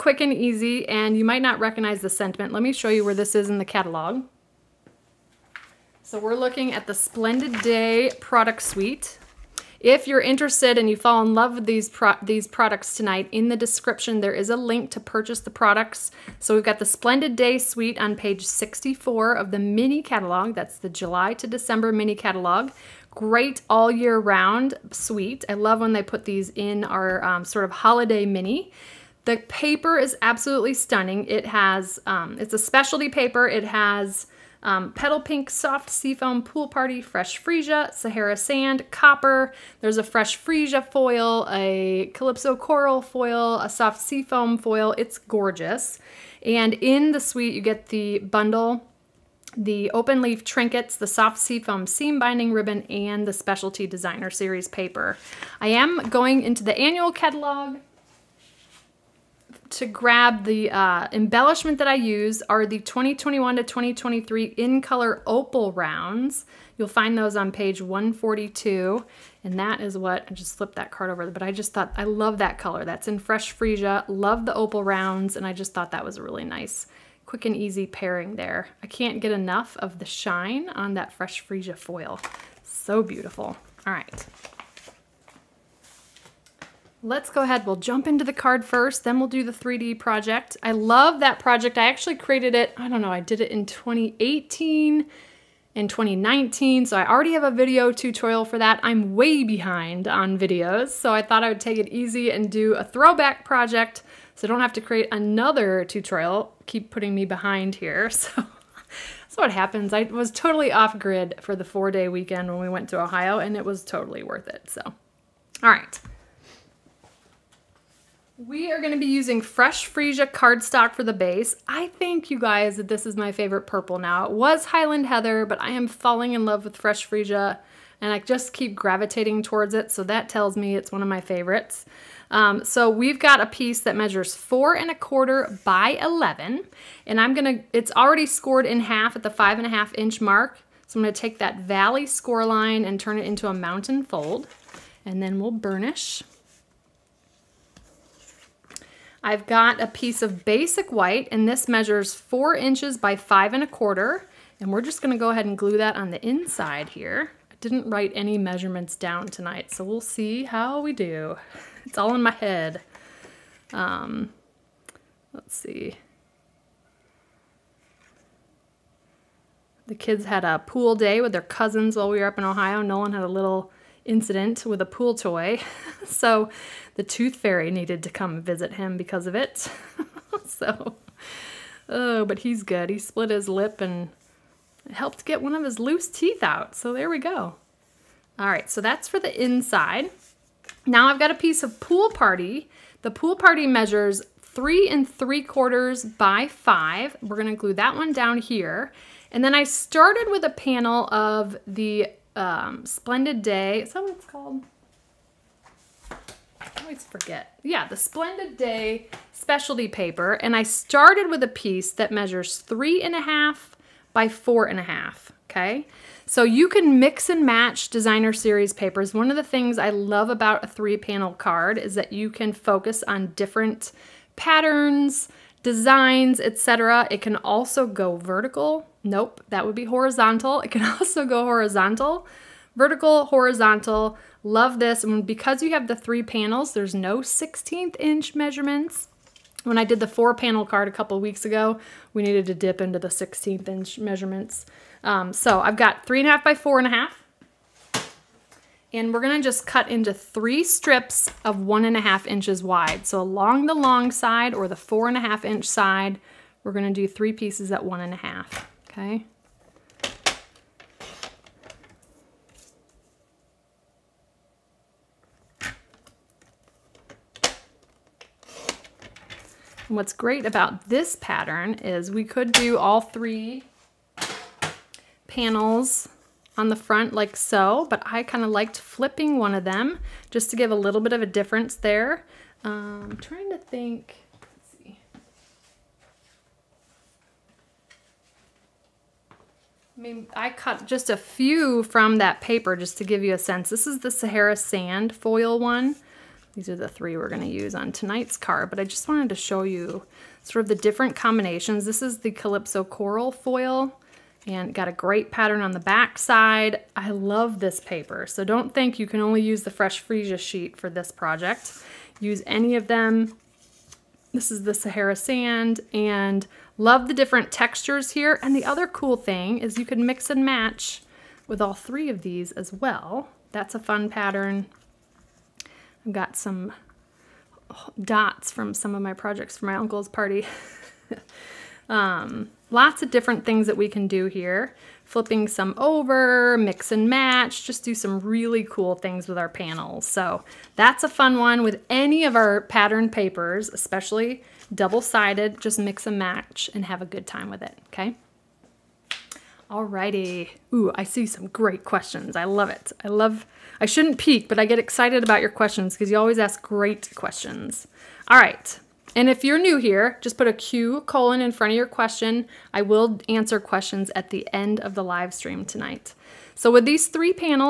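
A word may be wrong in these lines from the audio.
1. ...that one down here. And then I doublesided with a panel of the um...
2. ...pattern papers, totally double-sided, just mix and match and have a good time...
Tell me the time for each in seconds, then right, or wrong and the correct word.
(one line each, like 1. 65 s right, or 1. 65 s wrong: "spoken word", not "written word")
1. 197 s wrong: "started", not "doublesided"
2. 342 s wrong: "especially", not "totally".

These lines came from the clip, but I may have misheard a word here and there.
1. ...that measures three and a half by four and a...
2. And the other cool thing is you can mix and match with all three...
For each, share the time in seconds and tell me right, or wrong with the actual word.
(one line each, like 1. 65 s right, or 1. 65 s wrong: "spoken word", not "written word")
1. 211 s right
2. 318 s right.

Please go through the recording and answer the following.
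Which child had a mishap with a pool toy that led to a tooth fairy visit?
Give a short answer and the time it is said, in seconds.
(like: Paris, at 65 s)
Nolan, at 172 s.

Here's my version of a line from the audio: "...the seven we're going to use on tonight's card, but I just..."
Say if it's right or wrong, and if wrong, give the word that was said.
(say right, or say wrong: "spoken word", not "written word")
wrong: "three", not "seven".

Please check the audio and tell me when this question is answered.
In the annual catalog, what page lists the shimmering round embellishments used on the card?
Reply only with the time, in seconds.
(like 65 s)
67 s.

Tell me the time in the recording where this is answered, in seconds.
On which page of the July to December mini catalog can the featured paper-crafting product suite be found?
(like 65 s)
18 s.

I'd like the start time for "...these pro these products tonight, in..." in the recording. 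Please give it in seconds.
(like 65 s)
11 s.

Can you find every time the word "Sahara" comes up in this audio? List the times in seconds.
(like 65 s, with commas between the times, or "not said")
37 s, 294 s, 314 s.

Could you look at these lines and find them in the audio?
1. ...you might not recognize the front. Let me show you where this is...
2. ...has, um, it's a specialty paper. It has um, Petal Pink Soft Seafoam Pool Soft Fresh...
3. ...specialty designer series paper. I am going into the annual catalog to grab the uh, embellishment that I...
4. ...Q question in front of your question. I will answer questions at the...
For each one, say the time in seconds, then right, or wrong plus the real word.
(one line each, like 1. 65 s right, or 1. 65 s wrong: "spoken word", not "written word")
1. 1 s wrong: "sentiment", not "front"
2. 31 s wrong: "Party", not "Soft"
3. 53 s right
4. 360 s wrong: "colon", not "question".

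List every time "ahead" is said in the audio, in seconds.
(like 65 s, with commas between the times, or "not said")
87 s, 155 s.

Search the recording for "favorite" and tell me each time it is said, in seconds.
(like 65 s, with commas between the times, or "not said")
123 s, 131 s.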